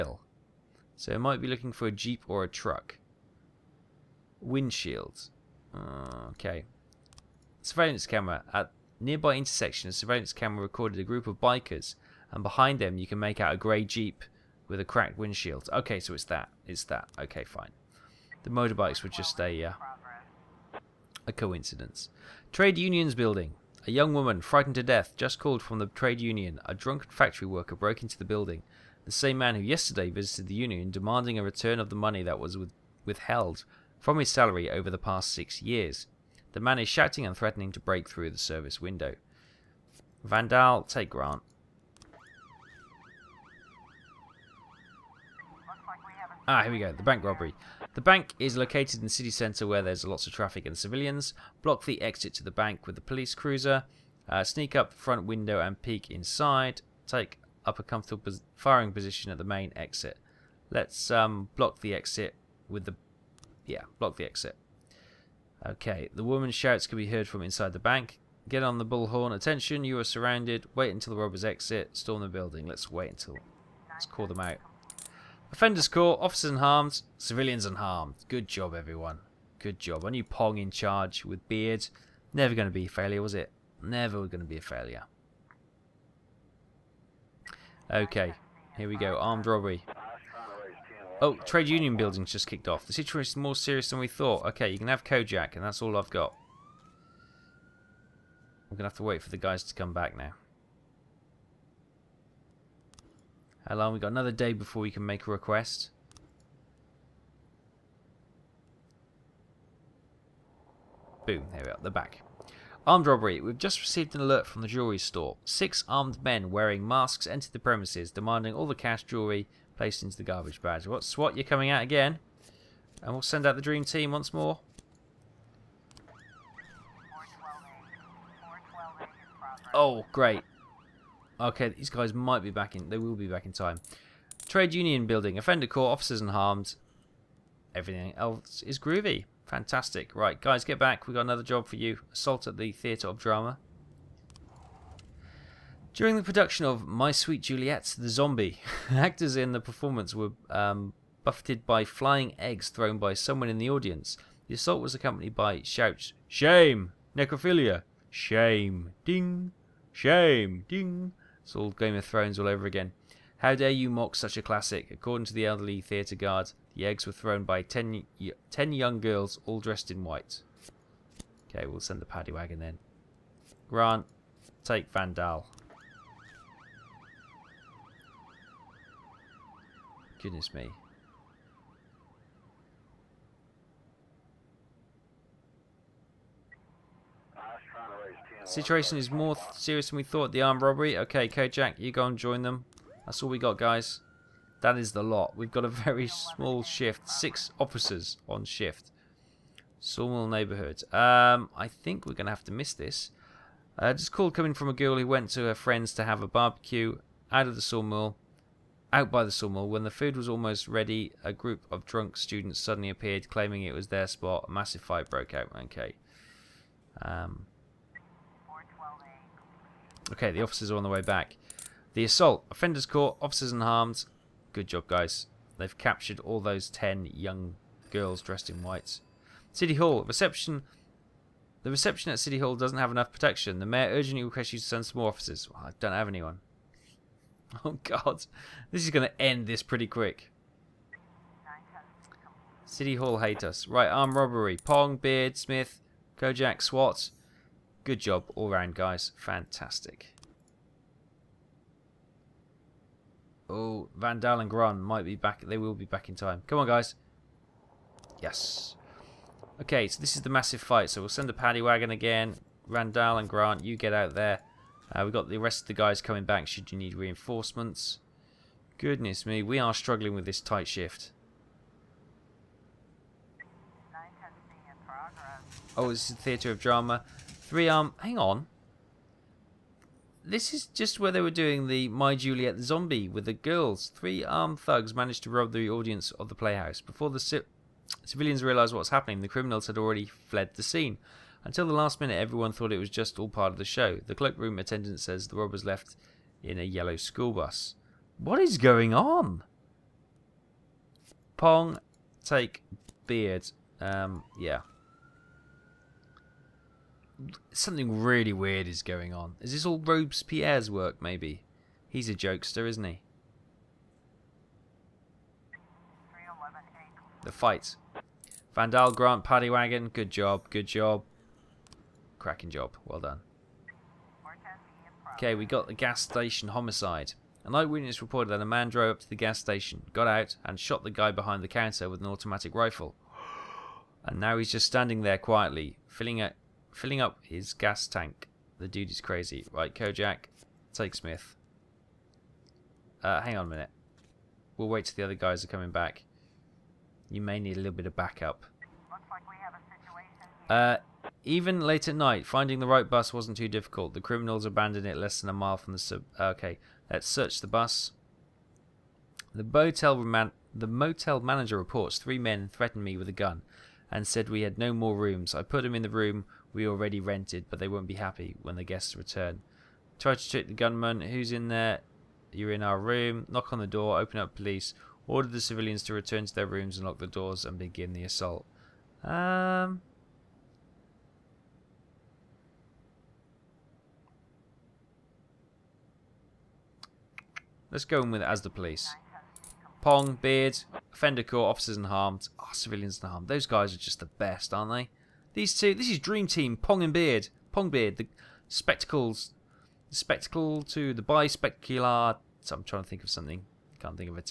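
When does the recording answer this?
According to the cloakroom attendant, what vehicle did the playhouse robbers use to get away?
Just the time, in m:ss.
4:56.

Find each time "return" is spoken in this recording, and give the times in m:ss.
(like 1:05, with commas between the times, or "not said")
0:31, 6:08, 6:15.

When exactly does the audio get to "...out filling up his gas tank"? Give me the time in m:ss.
5:36.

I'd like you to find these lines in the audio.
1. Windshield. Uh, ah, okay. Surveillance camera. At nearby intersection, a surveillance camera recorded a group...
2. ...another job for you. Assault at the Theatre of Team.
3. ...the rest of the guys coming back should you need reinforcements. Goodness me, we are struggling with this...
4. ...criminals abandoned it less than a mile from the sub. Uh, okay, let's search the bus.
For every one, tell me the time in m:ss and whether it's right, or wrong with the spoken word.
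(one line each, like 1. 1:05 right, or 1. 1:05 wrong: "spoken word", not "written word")
1. 0:04 right
2. 2:21 wrong: "Drama", not "Team"
3. 4:25 right
4. 5:53 right.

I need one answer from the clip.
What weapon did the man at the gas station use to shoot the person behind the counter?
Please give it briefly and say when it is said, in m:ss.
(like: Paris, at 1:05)
Automatic rifle, at 5:32.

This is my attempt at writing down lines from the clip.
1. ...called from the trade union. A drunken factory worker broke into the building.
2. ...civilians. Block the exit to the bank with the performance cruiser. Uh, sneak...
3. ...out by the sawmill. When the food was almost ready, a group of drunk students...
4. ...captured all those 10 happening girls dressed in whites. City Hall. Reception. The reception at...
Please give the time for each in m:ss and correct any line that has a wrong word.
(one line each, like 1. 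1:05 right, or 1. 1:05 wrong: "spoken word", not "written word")
1. 0:25 right
2. 0:50 wrong: "police", not "performance"
3. 3:28 right
4. 3:45 wrong: "young", not "happening".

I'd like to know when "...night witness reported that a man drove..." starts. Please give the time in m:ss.
5:27.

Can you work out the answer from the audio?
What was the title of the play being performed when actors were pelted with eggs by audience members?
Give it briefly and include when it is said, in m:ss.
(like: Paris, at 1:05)
My Sweet Juliet, the Zombie, at 2:26.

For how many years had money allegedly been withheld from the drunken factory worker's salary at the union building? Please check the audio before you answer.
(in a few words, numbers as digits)
6.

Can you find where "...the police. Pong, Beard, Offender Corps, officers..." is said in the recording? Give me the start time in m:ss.
6:28.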